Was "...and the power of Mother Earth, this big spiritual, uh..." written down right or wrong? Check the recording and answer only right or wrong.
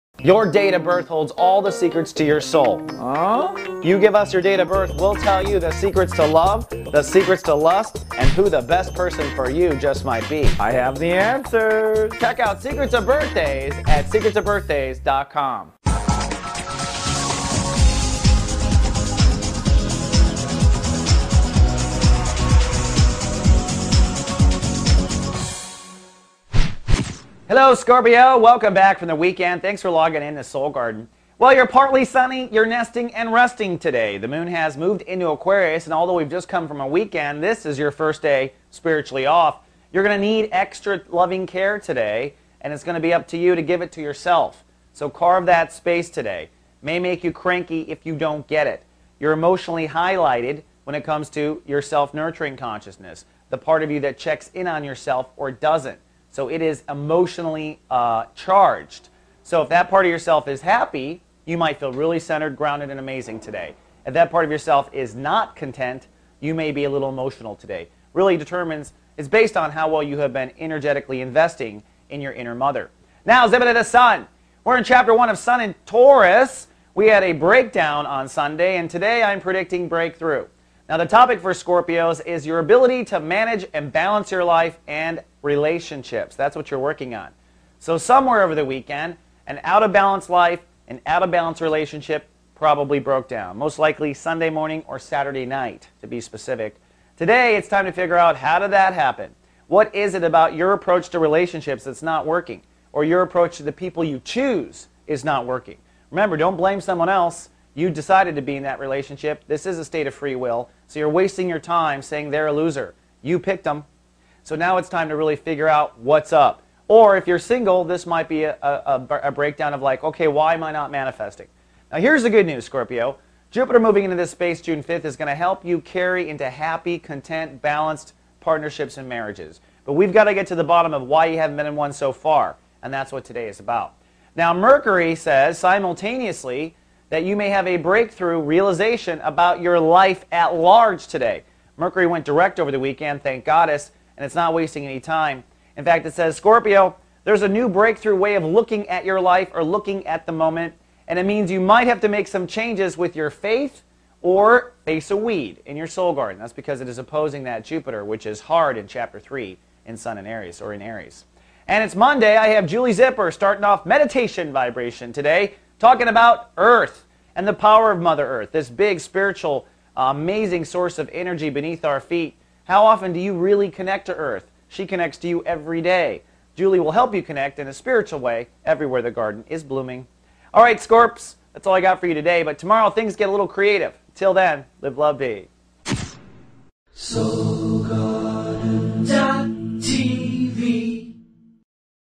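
right.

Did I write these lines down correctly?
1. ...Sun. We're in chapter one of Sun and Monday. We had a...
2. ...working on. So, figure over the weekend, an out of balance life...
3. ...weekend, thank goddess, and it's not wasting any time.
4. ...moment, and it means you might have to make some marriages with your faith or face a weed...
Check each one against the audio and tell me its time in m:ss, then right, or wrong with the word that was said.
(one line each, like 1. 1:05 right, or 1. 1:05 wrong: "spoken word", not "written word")
1. 1:13 wrong: "Taurus", not "Monday"
2. 1:26 wrong: "somewhere", not "figure"
3. 2:22 right
4. 2:30 wrong: "changes", not "marriages".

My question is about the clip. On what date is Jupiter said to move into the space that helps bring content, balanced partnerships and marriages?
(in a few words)
June 5th.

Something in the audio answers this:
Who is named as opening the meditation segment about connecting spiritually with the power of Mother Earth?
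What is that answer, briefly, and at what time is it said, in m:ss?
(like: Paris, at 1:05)
Julie Zipper, at 2:42.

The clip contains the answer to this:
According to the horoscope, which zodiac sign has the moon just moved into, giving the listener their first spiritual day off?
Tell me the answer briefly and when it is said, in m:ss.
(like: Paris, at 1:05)
Aquarius, at 0:35.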